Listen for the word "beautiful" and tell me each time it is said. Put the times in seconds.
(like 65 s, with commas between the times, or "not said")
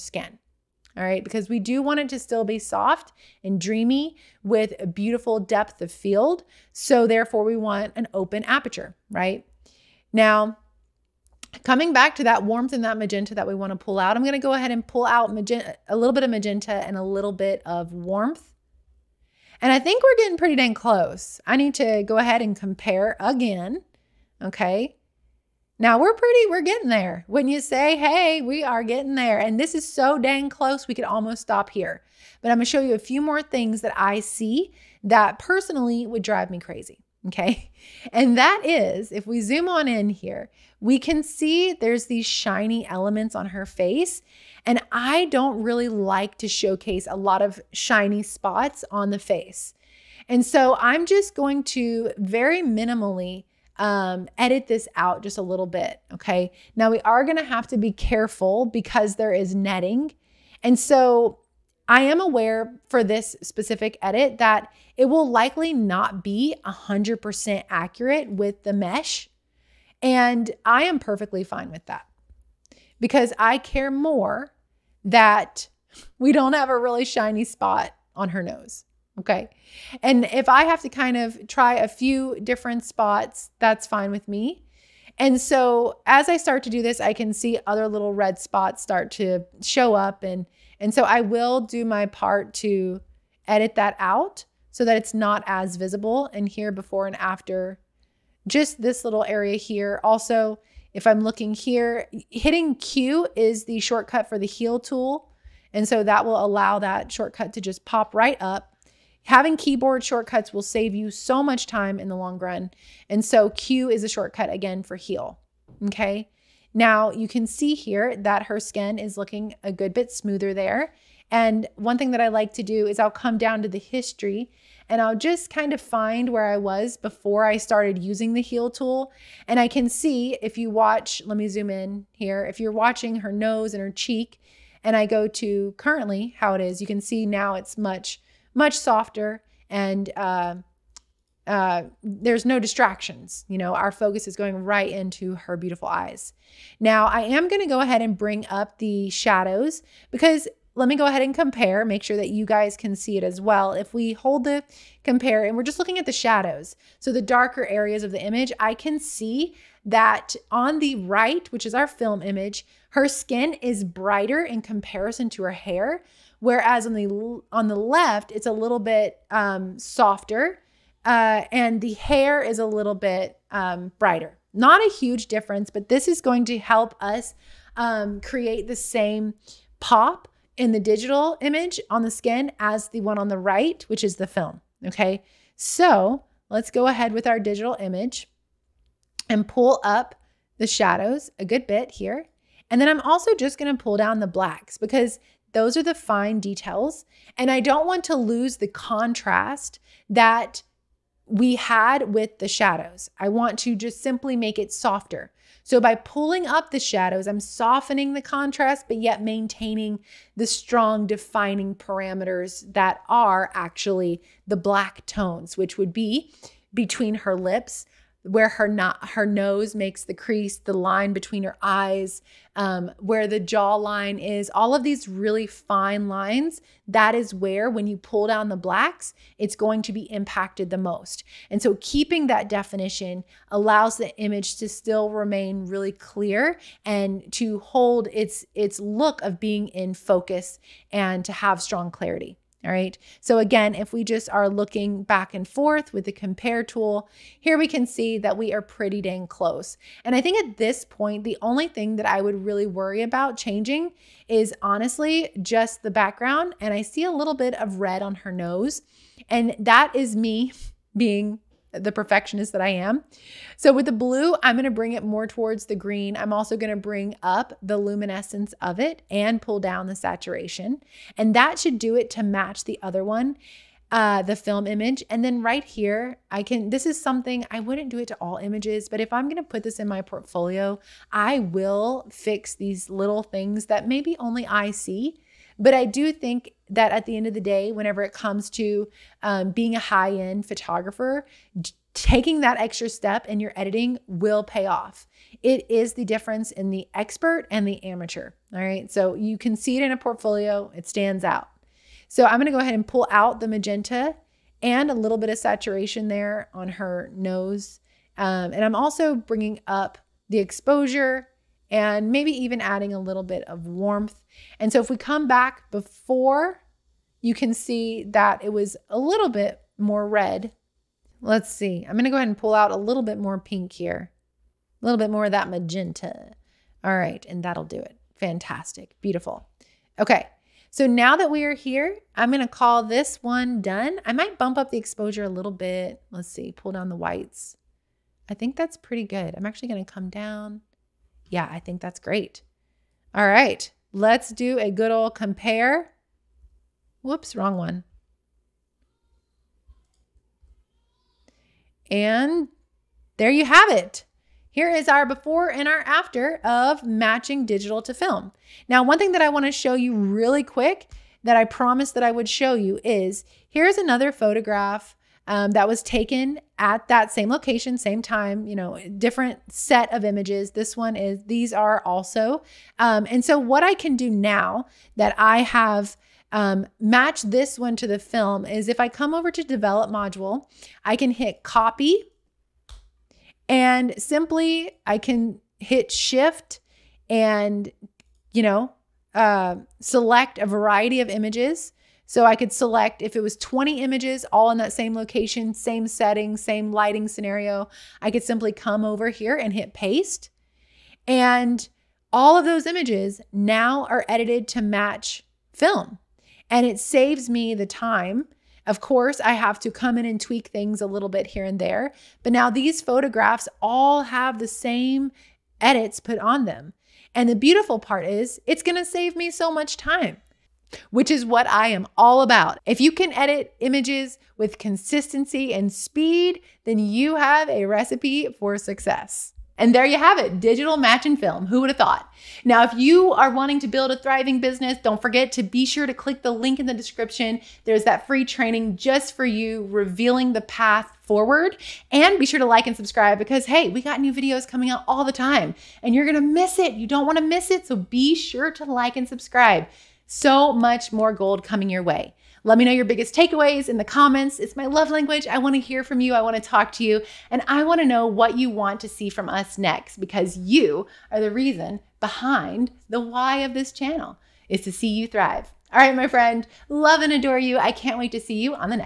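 4 s, 145 s, 329 s, 417 s.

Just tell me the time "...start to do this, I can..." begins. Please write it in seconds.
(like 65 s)
86 s.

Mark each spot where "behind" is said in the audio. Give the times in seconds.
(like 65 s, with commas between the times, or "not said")
462 s.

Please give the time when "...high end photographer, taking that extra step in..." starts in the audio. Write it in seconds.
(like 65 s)
289 s.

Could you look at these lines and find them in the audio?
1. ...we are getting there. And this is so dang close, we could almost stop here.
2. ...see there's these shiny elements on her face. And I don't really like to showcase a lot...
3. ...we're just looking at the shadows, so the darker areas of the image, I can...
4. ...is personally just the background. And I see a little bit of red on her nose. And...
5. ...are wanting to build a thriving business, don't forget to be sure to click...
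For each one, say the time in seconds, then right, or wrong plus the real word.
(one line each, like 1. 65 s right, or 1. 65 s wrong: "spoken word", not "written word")
1. 28 s right
2. 41 s right
3. 155 s right
4. 254 s wrong: "honestly", not "personally"
5. 433 s right.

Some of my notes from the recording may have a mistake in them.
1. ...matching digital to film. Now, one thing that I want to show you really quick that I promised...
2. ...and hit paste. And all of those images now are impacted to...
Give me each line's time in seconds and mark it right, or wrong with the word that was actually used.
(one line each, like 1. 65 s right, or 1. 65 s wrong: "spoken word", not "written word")
1. 356 s right
2. 399 s wrong: "edited", not "impacted".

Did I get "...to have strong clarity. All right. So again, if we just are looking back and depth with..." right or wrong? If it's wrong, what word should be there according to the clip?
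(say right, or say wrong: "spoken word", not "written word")
wrong: "forth", not "depth".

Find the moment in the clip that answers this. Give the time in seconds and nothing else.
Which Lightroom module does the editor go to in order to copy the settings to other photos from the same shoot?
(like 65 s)
379 s.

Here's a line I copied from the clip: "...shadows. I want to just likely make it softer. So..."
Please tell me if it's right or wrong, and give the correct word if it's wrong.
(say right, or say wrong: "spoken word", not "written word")
wrong: "simply", not "likely".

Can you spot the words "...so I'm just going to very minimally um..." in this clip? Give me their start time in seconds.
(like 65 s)
50 s.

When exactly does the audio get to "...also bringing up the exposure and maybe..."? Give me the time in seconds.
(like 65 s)
308 s.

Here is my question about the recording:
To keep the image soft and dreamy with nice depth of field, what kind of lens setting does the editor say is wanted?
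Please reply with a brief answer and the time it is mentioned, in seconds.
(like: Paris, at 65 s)
Open aperture, at 8 s.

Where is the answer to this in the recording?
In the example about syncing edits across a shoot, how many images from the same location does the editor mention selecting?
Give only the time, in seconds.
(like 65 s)
393 s.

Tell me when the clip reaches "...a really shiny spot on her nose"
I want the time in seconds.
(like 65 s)
76 s.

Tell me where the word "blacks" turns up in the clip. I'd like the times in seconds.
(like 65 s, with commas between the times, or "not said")
194 s, 214 s, 228 s.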